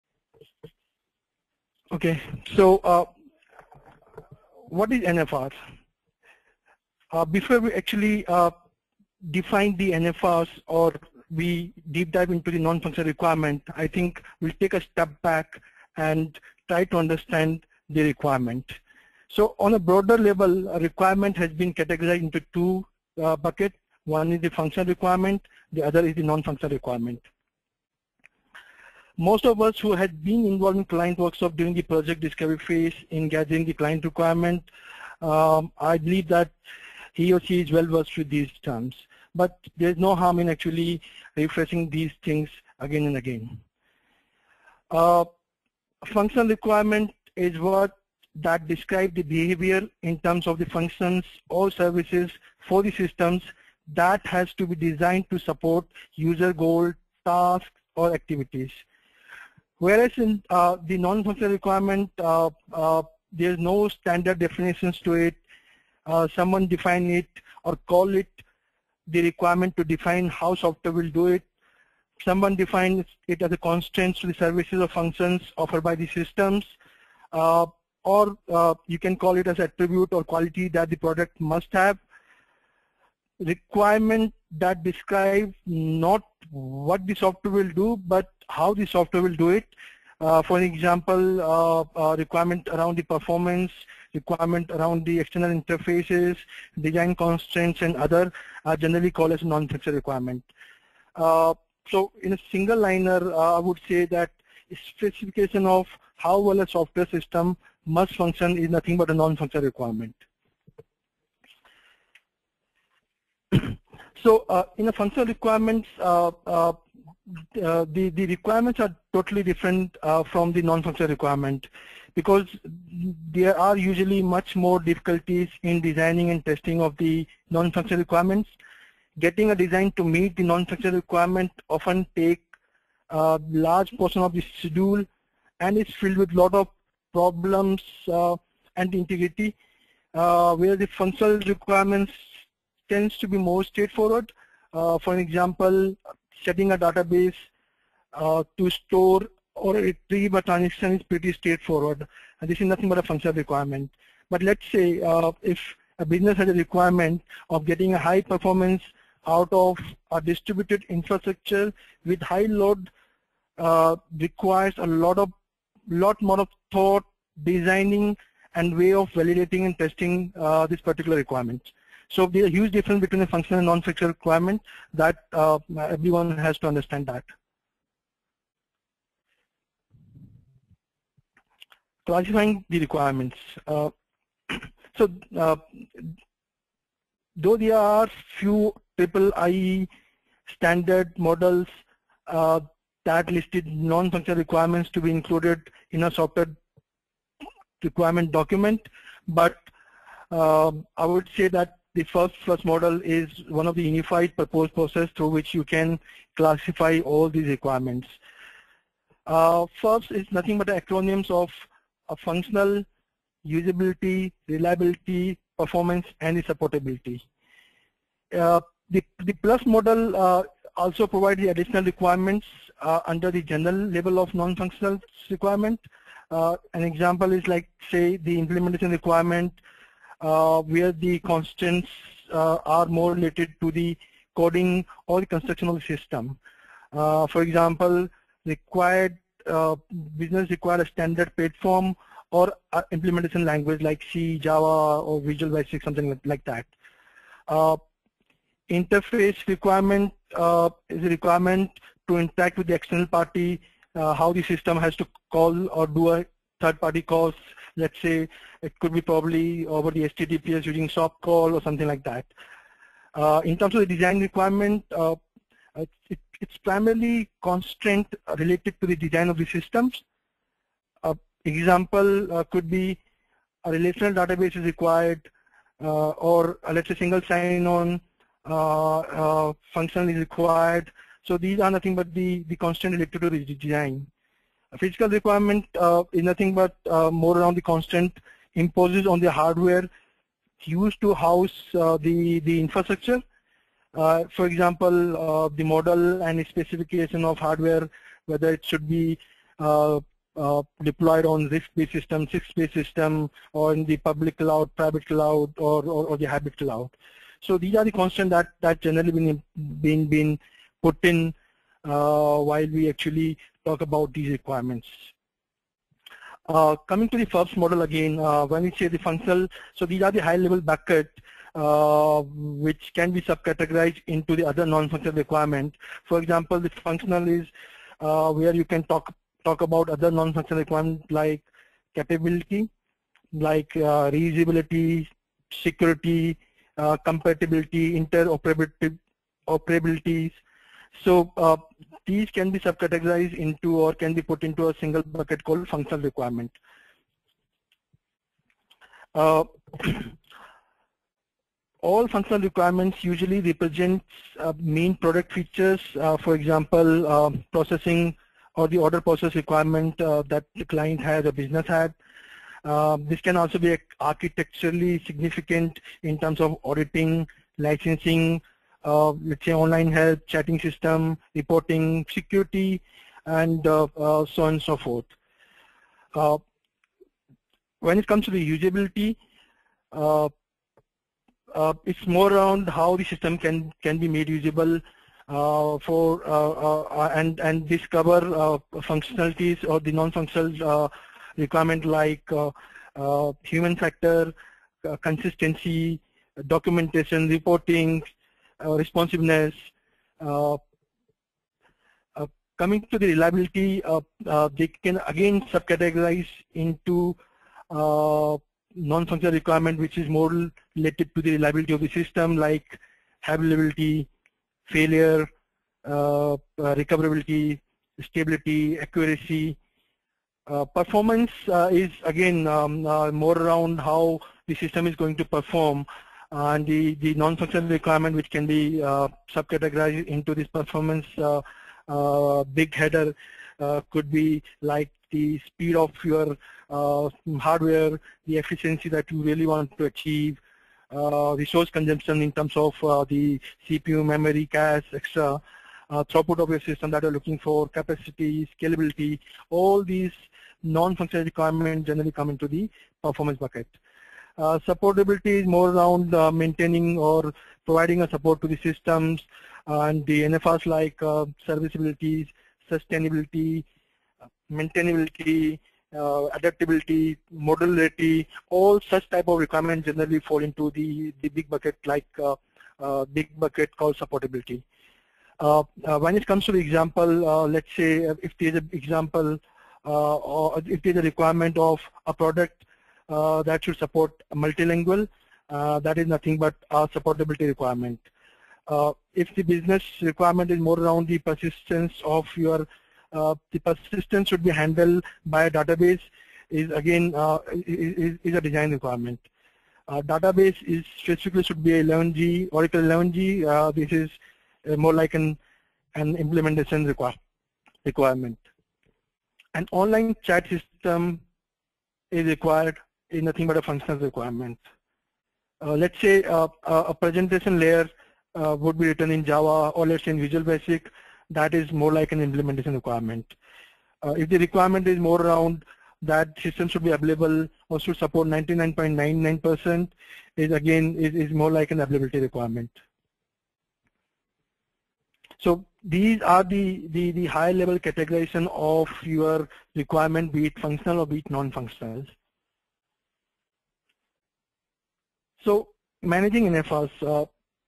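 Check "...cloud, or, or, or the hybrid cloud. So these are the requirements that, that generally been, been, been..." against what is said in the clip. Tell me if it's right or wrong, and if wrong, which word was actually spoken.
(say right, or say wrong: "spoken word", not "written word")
wrong: "constraints", not "requirements".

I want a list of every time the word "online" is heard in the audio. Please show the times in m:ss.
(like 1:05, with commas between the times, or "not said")
6:09, 8:29.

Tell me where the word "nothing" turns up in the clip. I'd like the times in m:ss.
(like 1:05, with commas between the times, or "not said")
1:48, 2:32, 3:30, 4:41, 4:46, 8:06, 8:33.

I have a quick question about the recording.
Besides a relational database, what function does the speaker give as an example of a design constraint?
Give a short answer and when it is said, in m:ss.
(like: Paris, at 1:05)
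Single sign-on, at 4:36.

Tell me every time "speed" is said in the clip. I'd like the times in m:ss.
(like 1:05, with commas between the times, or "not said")
7:15.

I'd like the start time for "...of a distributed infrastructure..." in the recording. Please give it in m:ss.
2:39.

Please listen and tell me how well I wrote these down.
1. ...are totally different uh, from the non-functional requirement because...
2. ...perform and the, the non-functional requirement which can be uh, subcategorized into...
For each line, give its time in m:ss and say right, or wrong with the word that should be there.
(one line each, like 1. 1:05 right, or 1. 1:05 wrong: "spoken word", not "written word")
1. 1:58 right
2. 7:05 right.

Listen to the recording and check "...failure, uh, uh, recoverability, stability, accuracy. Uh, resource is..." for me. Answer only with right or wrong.
wrong.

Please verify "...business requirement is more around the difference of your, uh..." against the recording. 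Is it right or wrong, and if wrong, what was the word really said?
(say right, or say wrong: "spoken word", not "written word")
wrong: "persistence", not "difference".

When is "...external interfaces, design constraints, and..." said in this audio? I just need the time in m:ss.
1:35.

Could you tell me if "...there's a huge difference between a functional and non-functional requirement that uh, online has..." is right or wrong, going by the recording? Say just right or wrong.
wrong.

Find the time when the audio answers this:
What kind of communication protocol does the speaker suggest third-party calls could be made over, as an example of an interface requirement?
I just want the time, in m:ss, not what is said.
4:20.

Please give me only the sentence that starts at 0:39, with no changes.
But there's no harm in actually refreshing these things again and again.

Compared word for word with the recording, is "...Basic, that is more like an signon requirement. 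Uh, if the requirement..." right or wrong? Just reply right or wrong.
wrong.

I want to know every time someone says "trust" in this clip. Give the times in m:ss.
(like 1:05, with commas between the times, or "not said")
not said.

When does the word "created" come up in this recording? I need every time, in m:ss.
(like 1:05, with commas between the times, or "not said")
not said.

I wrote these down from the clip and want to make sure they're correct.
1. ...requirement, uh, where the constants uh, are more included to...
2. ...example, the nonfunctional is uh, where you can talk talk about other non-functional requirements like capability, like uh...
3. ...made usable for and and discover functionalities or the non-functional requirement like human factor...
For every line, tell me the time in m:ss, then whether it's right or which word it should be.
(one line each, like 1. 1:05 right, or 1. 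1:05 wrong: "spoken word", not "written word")
1. 3:48 wrong: "related", not "included"
2. 5:26 wrong: "functional", not "nonfunctional"
3. 6:24 right.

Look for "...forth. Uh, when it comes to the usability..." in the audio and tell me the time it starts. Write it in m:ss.
6:14.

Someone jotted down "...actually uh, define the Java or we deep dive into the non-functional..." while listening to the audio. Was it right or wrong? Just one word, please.
wrong.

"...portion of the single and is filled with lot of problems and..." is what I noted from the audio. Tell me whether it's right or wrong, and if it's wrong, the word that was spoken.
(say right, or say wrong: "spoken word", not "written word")
wrong: "schedule", not "single".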